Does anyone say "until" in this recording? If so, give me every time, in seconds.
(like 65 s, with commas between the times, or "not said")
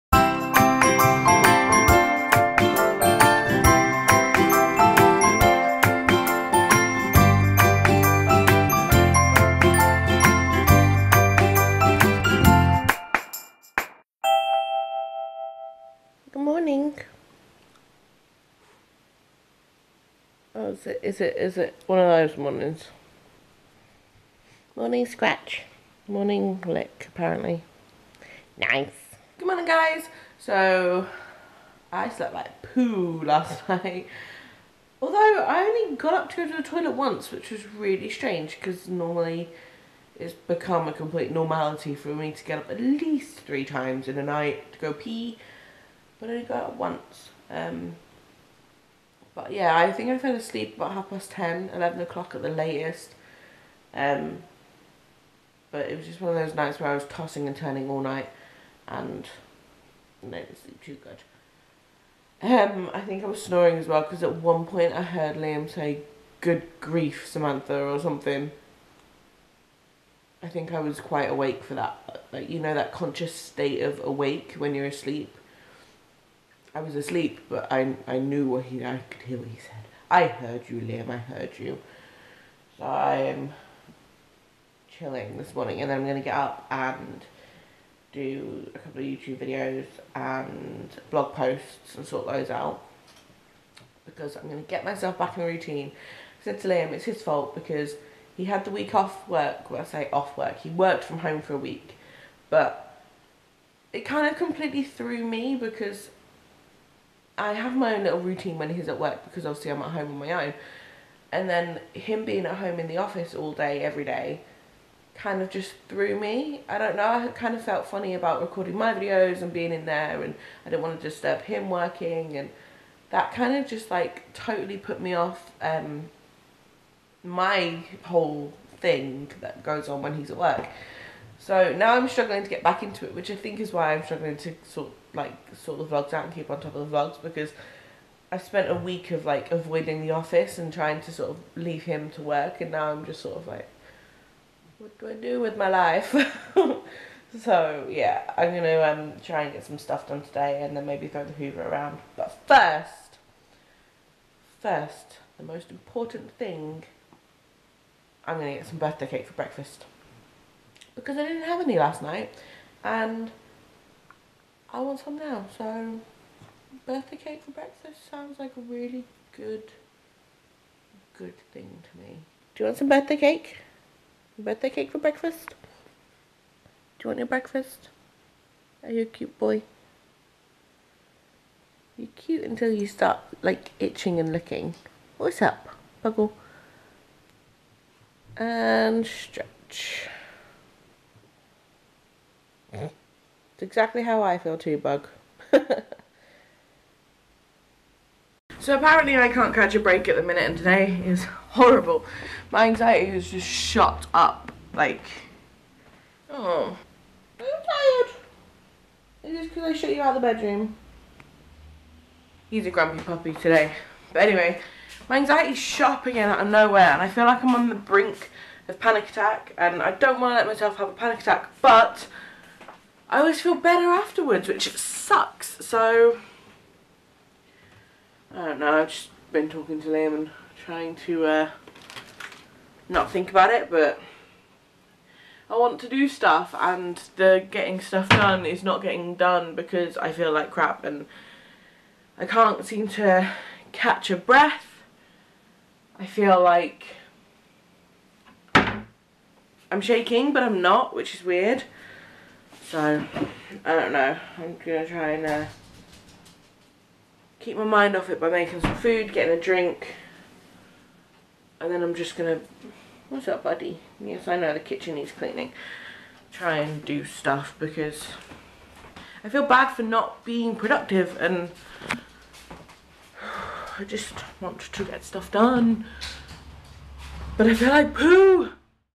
182 s.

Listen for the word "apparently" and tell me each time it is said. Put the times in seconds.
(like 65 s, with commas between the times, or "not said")
27 s, 198 s.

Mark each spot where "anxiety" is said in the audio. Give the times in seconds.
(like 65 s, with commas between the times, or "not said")
202 s, 215 s.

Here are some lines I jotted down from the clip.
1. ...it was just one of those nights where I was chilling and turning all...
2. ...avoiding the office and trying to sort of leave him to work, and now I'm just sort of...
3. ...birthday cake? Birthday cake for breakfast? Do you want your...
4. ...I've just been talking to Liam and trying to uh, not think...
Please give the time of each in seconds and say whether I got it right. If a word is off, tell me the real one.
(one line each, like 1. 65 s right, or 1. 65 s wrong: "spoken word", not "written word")
1. 55 s wrong: "tossing", not "chilling"
2. 139 s right
3. 172 s right
4. 228 s right.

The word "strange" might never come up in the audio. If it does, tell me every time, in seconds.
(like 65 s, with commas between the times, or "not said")
38 s.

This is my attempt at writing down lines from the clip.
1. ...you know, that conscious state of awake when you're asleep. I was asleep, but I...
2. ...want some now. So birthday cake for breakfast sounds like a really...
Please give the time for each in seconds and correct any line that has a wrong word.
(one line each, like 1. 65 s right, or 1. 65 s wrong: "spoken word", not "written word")
1. 72 s right
2. 164 s right.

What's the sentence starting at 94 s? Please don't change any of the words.
Because I'm going to get myself back in a routine.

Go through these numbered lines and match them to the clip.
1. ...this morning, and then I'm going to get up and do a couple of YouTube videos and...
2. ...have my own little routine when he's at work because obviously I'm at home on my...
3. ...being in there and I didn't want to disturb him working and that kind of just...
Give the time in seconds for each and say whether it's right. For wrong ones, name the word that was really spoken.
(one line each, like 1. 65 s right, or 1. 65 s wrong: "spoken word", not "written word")
1. 85 s right
2. 107 s right
3. 119 s right.